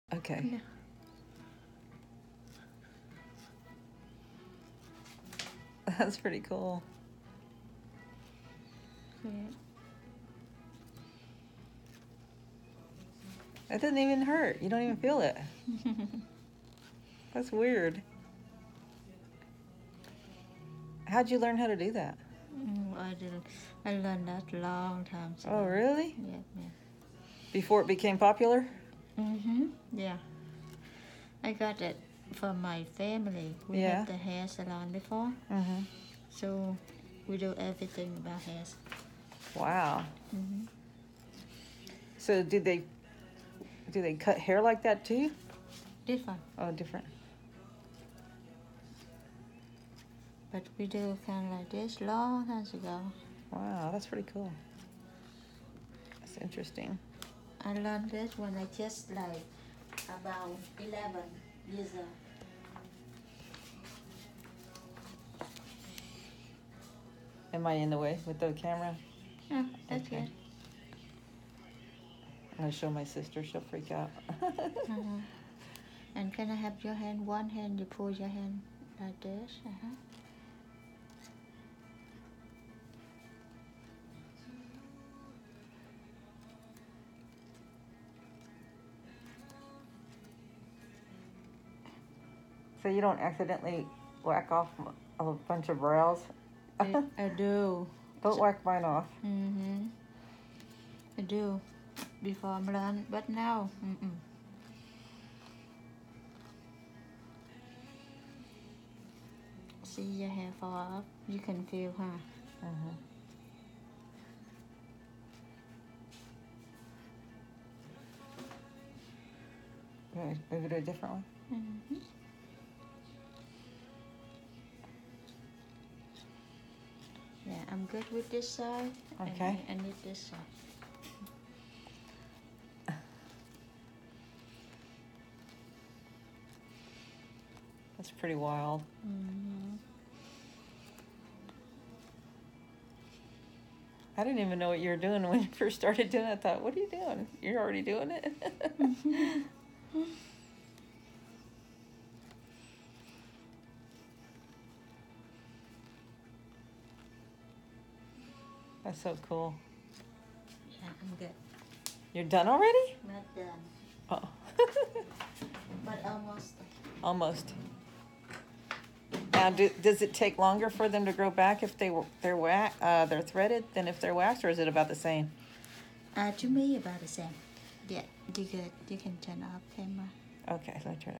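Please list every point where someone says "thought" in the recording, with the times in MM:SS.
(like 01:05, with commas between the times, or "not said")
02:26.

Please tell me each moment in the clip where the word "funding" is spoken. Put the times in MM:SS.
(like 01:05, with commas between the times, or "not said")
not said.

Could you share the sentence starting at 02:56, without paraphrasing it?
Uh, to me, about the same.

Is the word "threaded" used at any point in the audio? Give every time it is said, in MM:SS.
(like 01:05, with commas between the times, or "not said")
02:53.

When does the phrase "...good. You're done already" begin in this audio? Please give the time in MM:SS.
02:41.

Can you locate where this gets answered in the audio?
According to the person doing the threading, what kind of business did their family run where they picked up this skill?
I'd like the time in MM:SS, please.
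00:34.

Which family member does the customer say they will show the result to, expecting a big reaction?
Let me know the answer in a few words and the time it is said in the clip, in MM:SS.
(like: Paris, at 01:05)
sister, at 01:12.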